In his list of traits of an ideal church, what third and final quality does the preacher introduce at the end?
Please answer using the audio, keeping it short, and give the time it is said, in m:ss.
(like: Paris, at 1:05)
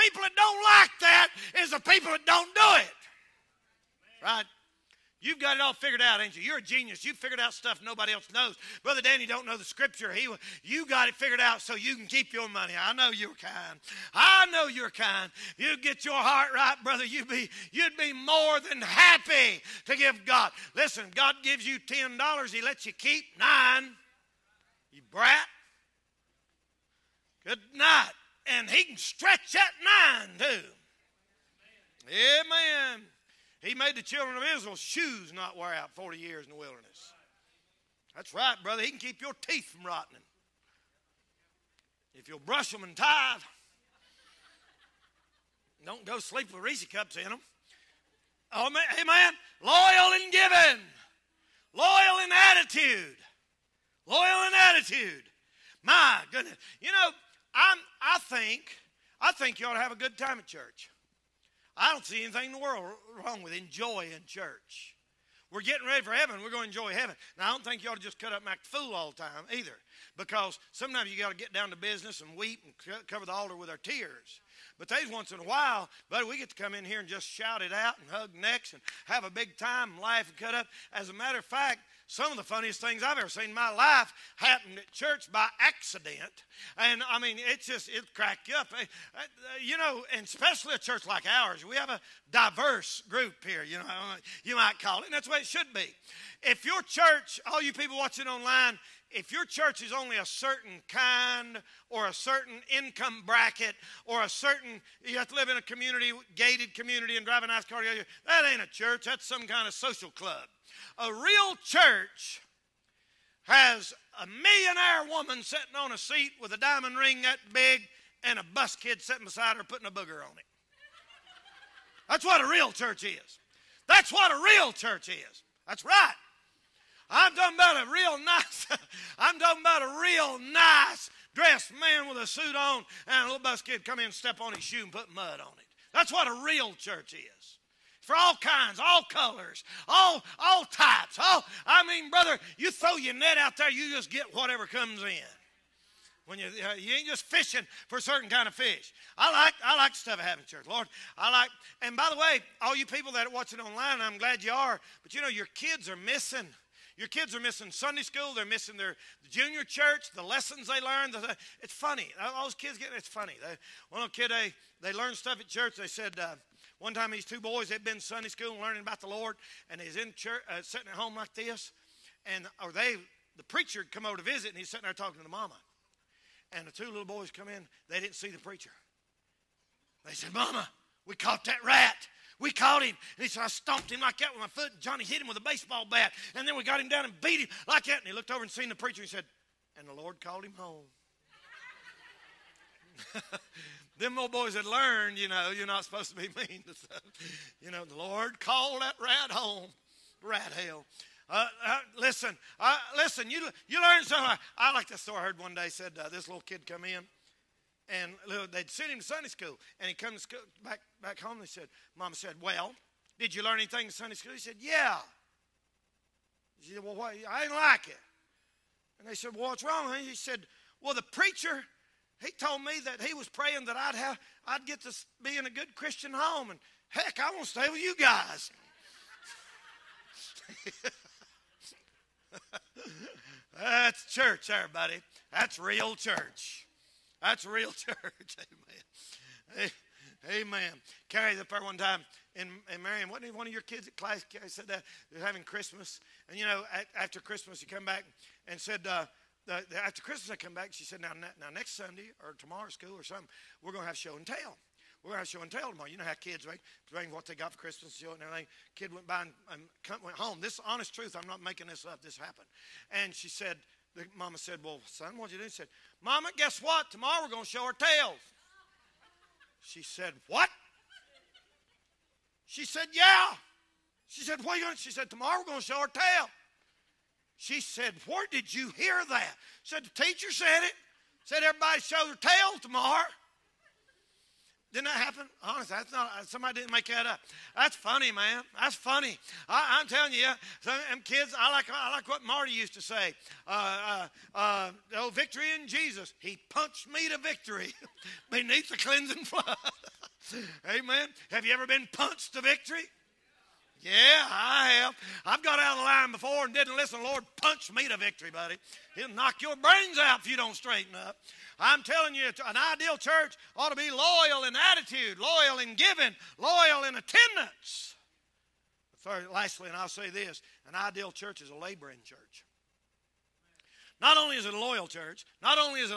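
A laboring church, at 5:21.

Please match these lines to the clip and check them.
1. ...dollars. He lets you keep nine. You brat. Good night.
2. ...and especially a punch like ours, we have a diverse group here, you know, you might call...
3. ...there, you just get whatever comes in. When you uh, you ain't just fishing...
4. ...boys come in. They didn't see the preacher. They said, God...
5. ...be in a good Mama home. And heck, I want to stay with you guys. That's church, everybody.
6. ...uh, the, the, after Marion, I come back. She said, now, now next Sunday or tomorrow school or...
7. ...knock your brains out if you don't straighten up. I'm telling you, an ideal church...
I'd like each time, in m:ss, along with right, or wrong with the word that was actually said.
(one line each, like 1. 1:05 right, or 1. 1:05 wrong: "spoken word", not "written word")
1. 0:22 right
2. 1:30 wrong: "church", not "punch"
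3. 2:23 right
4. 2:57 wrong: "Mama", not "God"
5. 3:45 wrong: "Christian", not "Mama"
6. 4:08 wrong: "Christmas", not "Marion"
7. 5:09 right.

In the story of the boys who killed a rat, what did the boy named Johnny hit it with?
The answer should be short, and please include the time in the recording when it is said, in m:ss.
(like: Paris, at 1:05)
A baseball bat, at 3:05.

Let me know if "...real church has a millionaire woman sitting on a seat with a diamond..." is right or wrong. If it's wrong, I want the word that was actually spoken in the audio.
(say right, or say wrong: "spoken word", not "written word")
right.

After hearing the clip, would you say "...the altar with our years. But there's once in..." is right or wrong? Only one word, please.
wrong.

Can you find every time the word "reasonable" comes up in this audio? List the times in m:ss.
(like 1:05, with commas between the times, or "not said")
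not said.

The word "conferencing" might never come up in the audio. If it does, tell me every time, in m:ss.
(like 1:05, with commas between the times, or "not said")
not said.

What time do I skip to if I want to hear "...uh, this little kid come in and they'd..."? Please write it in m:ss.
3:26.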